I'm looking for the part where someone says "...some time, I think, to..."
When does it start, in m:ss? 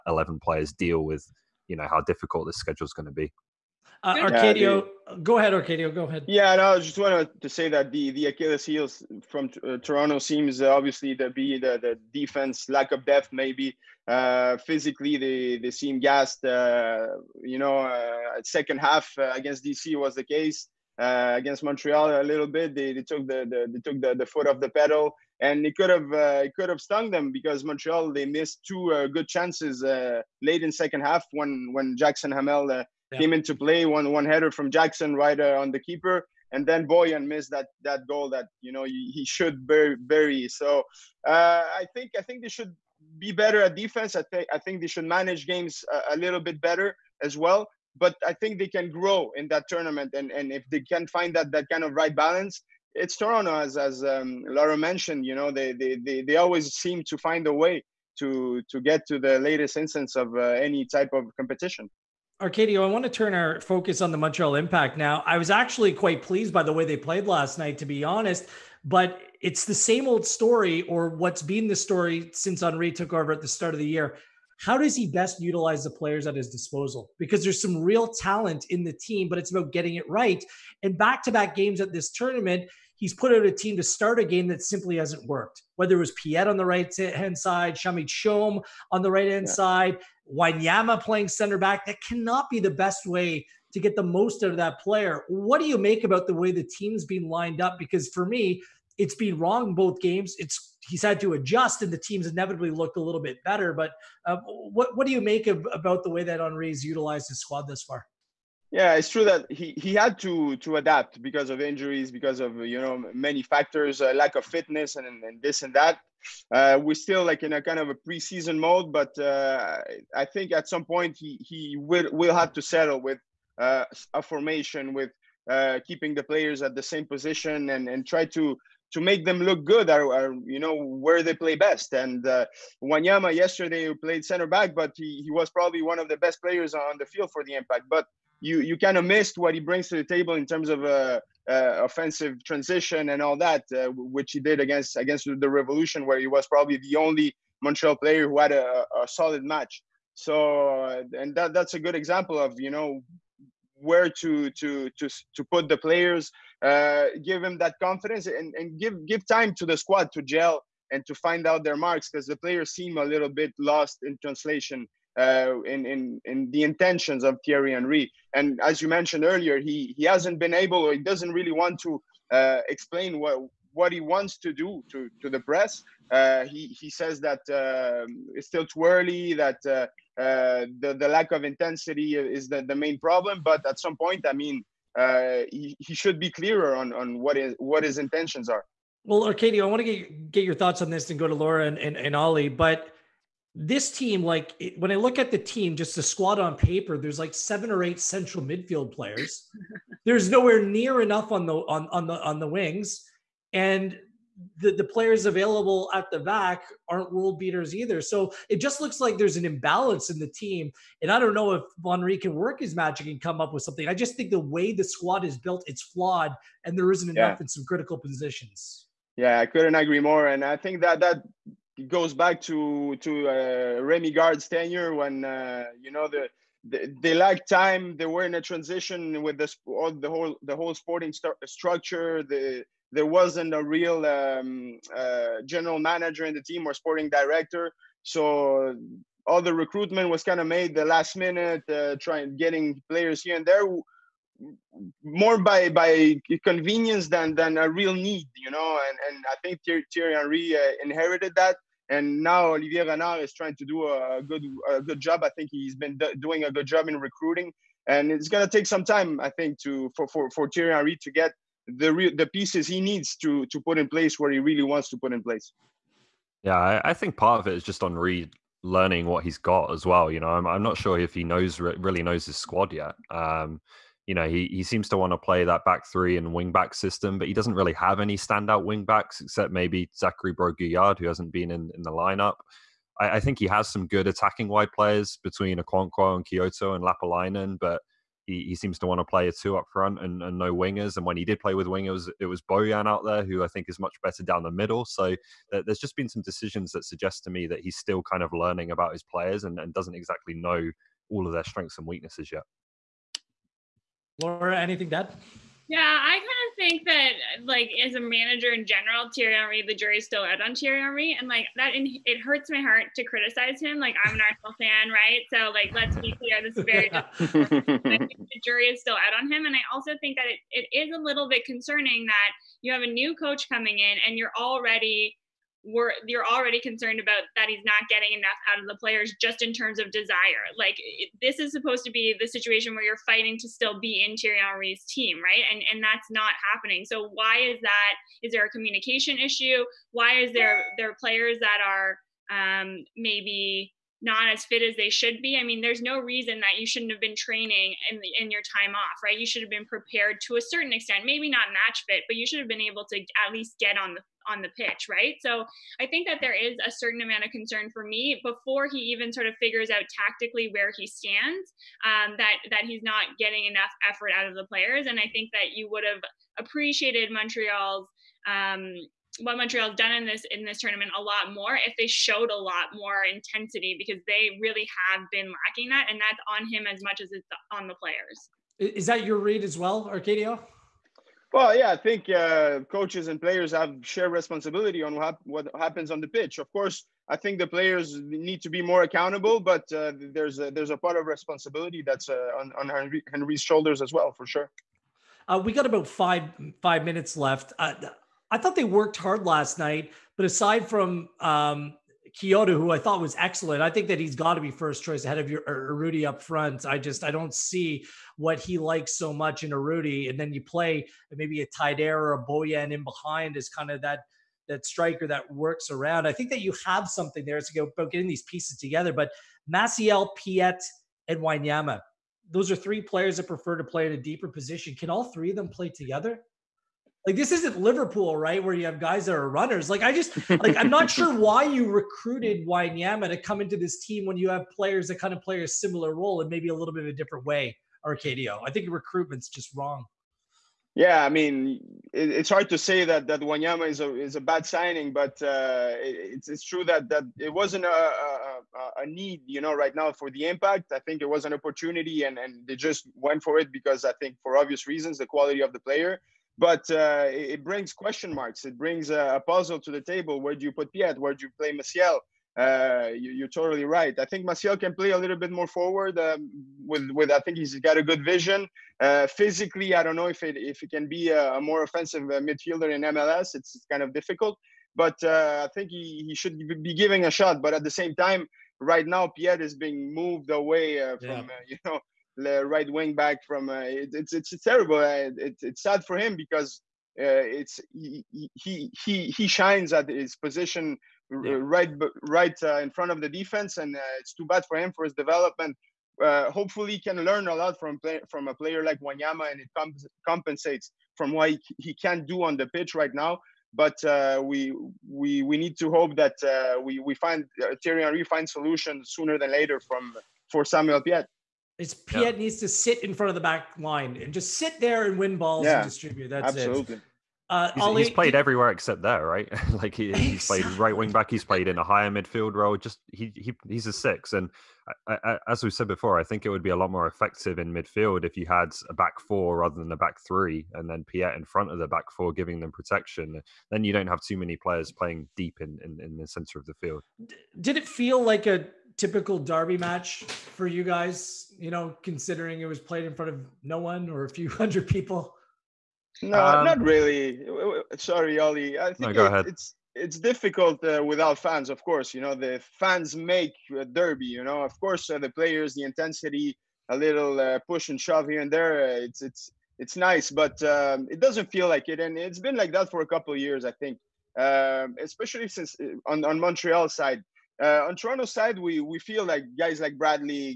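4:18.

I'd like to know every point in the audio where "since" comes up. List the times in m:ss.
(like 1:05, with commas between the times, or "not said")
1:12, 9:25.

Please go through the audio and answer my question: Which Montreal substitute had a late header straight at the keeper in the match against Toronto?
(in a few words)
Jackson Hamel.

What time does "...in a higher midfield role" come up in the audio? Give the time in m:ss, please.
8:41.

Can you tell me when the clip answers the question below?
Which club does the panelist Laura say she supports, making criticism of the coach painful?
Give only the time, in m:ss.
5:14.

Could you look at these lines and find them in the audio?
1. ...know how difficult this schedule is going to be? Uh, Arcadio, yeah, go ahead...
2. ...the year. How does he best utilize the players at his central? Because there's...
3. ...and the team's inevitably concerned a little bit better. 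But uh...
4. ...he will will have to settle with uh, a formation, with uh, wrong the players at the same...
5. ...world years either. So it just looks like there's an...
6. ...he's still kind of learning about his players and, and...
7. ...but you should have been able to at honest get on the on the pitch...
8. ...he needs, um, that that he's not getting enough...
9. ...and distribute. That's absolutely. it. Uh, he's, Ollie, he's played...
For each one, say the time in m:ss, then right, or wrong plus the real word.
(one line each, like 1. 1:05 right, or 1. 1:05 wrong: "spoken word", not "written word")
1. 0:01 right
2. 1:13 wrong: "disposal", not "central"
3. 1:41 wrong: "looked", not "concerned"
4. 2:01 wrong: "keeping", not "wrong"
5. 3:27 wrong: "beaters", not "years"
6. 4:57 right
7. 5:52 wrong: "least", not "honest"
8. 6:00 wrong: "stands", not "needs"
9. 8:35 right.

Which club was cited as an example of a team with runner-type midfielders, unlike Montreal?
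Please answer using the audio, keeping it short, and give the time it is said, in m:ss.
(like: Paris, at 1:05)
Liverpool, at 7:07.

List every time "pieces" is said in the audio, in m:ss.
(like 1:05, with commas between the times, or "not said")
4:22, 6:58.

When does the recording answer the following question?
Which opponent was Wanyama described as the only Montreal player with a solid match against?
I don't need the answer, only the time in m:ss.
2:25.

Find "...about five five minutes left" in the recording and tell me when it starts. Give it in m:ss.
6:35.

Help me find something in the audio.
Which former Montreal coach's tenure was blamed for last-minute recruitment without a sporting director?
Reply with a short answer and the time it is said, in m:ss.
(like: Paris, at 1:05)
Remi Garde, at 3:43.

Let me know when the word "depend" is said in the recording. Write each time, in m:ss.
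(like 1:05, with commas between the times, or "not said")
not said.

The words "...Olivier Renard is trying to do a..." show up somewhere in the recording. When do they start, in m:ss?
4:12.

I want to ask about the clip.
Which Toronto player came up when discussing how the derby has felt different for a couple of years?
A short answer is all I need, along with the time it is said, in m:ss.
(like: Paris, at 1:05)
Bradley, at 9:29.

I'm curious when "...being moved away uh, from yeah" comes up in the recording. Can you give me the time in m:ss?
7:59.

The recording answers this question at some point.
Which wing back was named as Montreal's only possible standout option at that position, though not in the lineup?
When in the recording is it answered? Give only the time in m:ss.
4:39.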